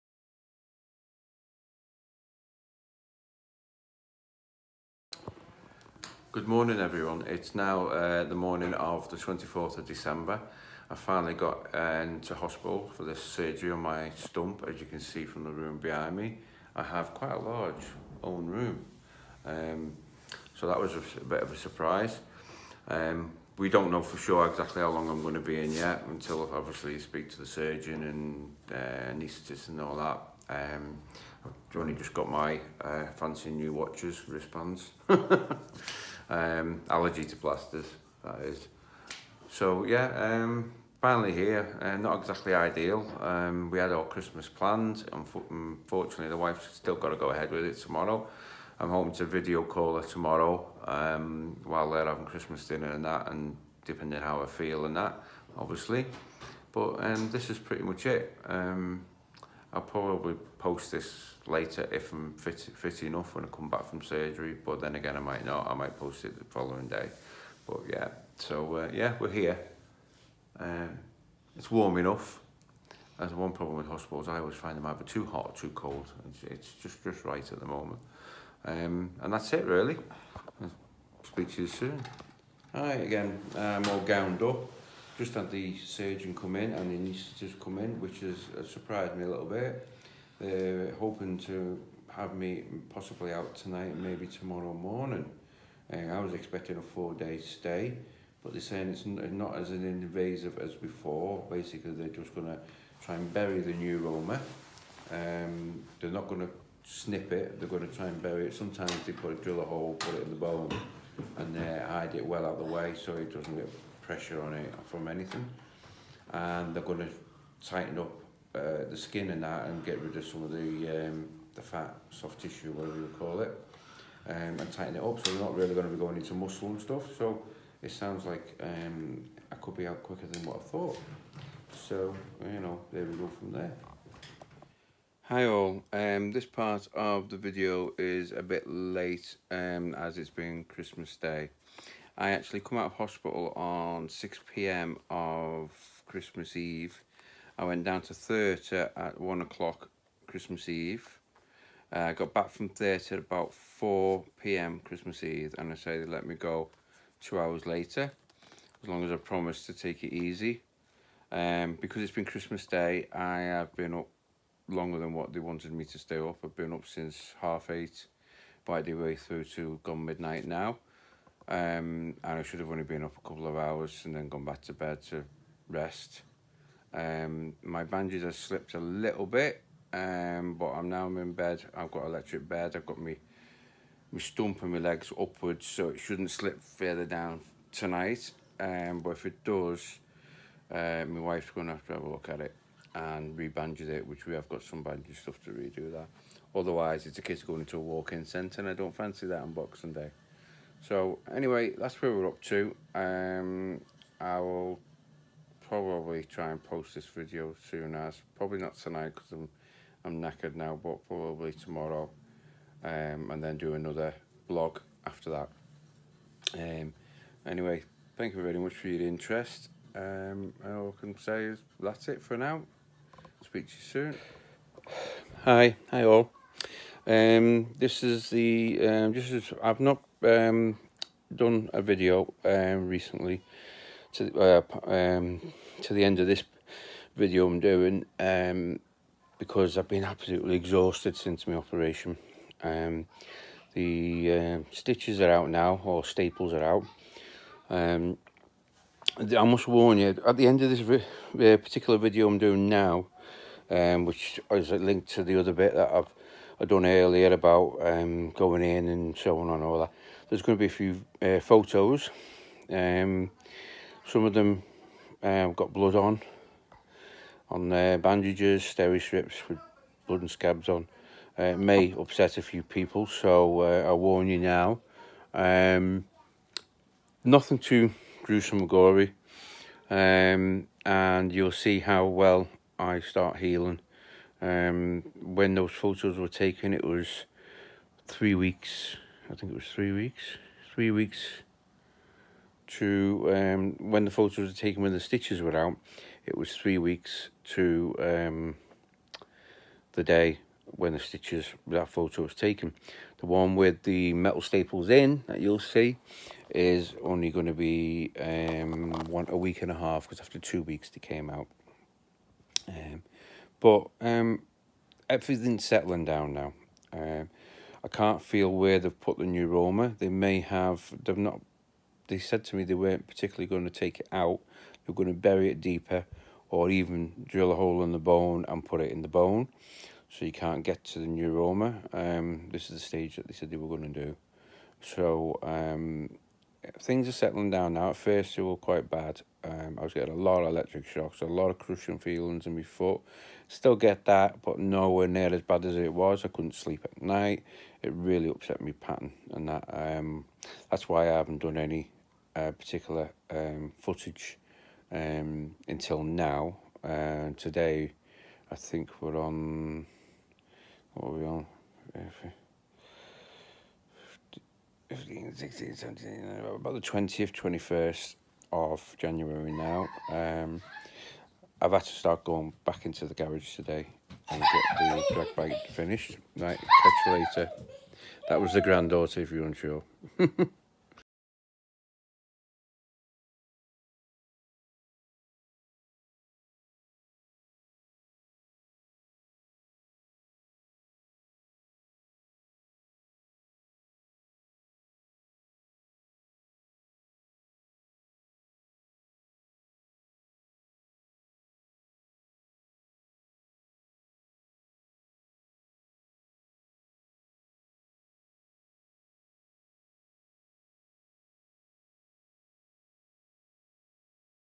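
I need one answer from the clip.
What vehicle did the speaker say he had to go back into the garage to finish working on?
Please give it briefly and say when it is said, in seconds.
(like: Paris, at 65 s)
Drag bike, at 375 s.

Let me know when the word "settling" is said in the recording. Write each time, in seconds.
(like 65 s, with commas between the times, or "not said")
315 s, 337 s.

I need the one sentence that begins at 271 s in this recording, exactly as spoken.
Uh, it may upset a few people, so uh, I warn you now.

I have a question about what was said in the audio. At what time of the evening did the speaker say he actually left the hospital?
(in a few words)
6pm.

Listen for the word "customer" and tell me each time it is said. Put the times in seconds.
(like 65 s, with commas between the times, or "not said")
not said.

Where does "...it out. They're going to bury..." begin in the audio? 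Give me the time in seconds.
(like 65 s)
324 s.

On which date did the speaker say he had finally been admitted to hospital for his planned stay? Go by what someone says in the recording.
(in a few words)
24th of December.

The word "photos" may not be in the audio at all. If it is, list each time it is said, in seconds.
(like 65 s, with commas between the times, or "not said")
261 s, 285 s, 294 s, 301 s.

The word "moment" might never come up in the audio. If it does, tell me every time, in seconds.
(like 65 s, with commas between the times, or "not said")
77 s.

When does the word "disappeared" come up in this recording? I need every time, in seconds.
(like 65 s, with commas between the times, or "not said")
not said.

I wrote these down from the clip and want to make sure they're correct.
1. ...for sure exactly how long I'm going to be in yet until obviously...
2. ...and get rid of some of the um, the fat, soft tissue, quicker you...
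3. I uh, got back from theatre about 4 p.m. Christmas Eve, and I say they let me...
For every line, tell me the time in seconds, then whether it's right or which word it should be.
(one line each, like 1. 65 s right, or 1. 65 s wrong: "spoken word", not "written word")
1. 24 s right
2. 119 s wrong: "whatever", not "quicker"
3. 151 s right.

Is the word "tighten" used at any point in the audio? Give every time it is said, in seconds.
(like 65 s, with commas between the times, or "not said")
117 s, 124 s.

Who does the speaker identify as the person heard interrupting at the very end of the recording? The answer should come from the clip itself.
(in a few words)
Granddaughter.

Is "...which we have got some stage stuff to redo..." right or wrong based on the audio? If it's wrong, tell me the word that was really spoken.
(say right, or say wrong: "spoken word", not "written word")
wrong: "bandage", not "stage".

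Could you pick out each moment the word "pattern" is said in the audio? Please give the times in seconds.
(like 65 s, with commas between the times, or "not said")
348 s.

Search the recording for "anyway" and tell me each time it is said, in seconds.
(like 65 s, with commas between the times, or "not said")
201 s, 217 s.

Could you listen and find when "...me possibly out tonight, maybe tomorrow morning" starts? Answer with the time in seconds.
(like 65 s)
92 s.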